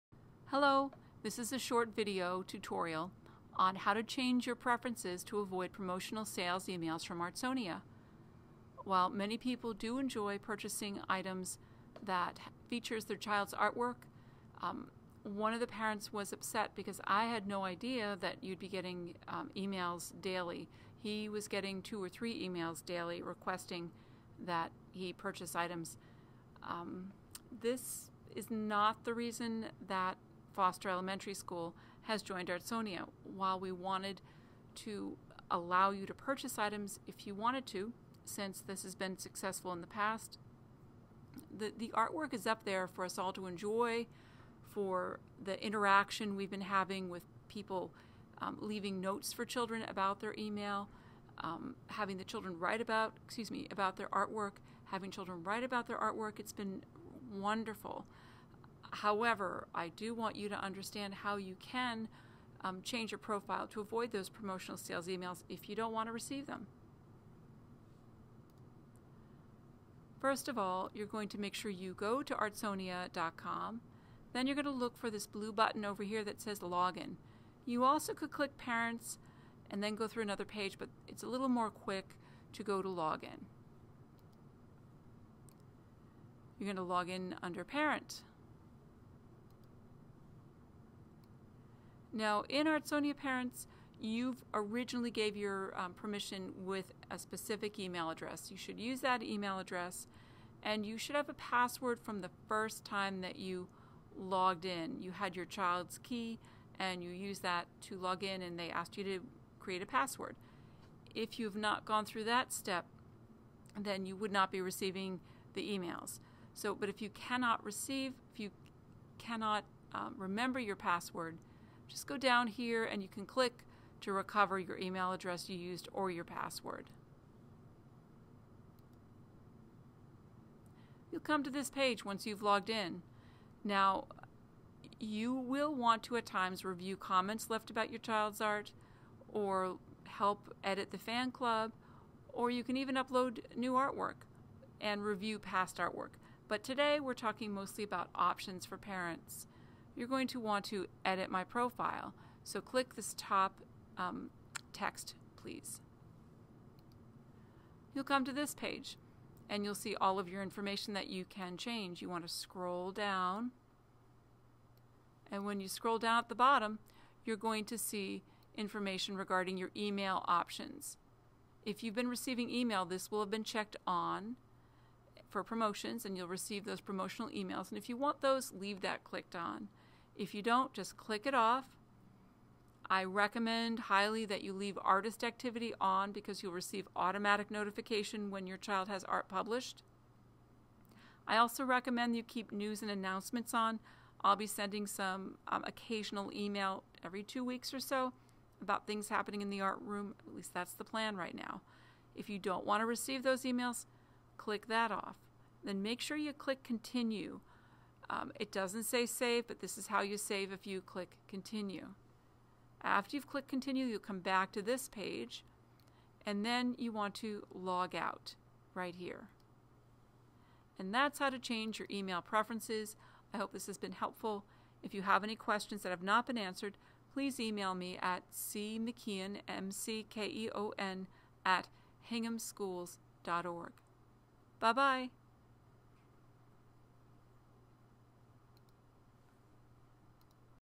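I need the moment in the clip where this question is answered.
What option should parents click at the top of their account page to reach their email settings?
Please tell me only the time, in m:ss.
2:31.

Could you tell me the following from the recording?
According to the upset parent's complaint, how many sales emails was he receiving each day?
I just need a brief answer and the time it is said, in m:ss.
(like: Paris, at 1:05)
two or three, at 0:21.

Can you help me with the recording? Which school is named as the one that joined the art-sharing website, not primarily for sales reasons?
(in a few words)
Foster Elementary School.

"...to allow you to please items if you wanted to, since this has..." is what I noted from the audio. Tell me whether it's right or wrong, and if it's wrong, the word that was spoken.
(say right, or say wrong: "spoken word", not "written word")
wrong: "purchase", not "please".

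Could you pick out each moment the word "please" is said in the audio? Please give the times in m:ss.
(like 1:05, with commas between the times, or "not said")
2:35, 3:47.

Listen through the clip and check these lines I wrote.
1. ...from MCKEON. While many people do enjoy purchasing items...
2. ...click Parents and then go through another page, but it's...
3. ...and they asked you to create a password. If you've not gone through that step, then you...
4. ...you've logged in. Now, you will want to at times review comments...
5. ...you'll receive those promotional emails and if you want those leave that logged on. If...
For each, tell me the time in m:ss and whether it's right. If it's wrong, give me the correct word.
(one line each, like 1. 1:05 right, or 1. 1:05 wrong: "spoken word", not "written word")
1. 0:07 wrong: "Artsonia", not "MCKEON"
2. 1:18 right
3. 1:48 right
4. 2:12 right
5. 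2:56 wrong: "clicked", not "logged".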